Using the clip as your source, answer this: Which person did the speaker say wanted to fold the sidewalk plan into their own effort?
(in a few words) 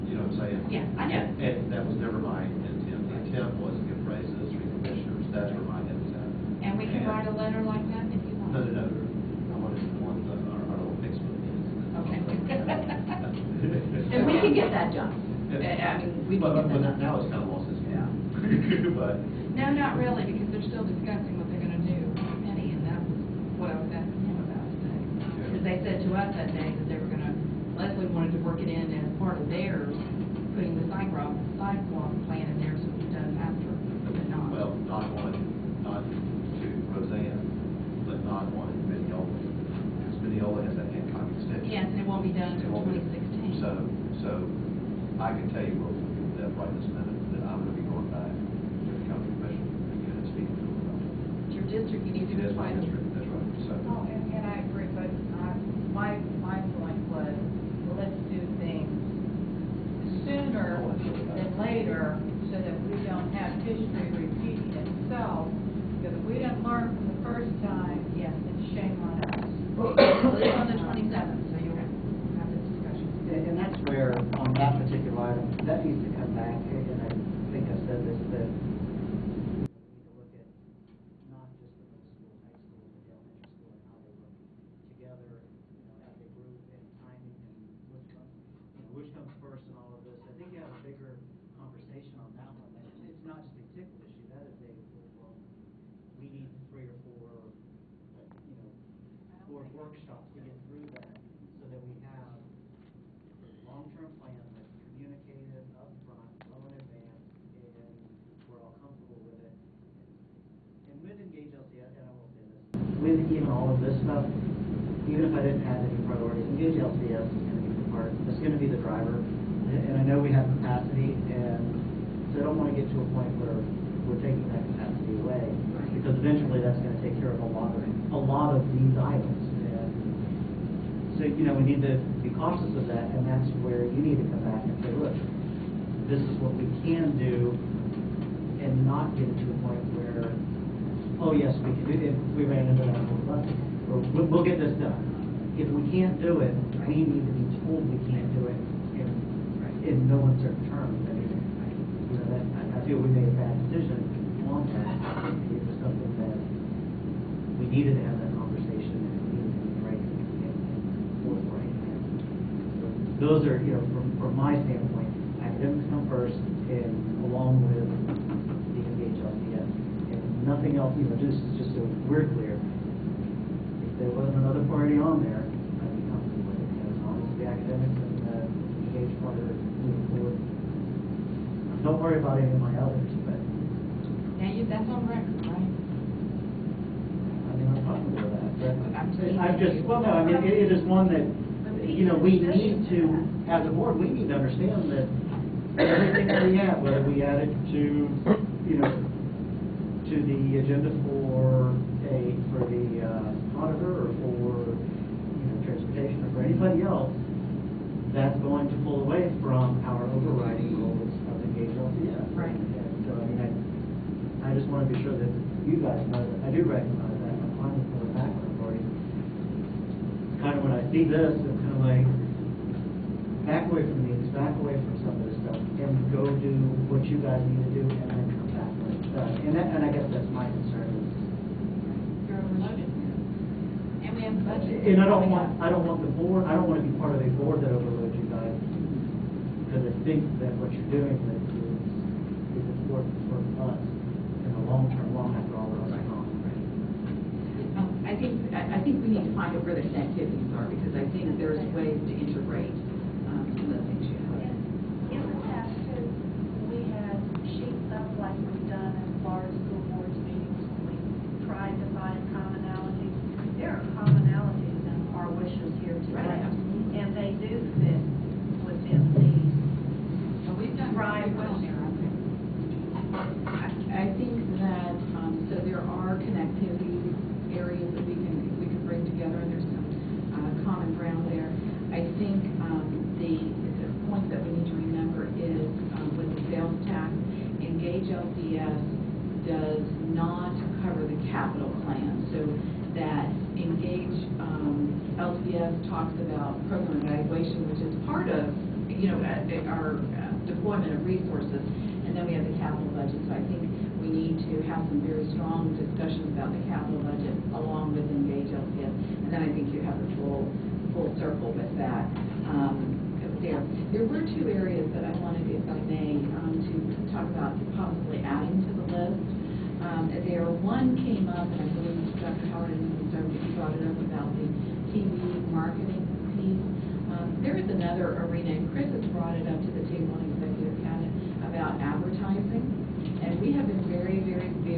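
Leslie.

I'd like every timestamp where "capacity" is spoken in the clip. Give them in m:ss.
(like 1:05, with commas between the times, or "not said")
2:00, 2:04.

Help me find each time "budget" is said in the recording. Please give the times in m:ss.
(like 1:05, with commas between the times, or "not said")
3:54, 5:02, 5:07.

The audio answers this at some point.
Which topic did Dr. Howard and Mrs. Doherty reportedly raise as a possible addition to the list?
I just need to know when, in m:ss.
5:24.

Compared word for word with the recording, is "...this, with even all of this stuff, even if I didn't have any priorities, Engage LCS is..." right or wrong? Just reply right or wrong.
right.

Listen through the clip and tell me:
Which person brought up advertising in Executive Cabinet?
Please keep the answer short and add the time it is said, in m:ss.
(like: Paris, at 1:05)
Chris, at 5:28.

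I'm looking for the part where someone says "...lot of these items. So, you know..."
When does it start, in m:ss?
2:08.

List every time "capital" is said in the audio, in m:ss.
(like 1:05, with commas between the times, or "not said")
5:02, 5:06.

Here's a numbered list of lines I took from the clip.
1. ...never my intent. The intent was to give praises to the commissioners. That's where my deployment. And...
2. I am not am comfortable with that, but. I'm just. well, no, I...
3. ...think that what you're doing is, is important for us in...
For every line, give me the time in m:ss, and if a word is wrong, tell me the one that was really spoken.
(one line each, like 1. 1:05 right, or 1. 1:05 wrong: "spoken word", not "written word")
1. 0:02 wrong: "intent", not "deployment"
2. 3:05 right
3. 4:00 right.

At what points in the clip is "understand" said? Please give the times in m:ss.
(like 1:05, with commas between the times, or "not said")
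3:14.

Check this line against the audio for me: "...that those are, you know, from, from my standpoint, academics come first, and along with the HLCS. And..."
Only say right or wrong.
right.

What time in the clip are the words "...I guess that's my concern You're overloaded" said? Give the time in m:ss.
3:49.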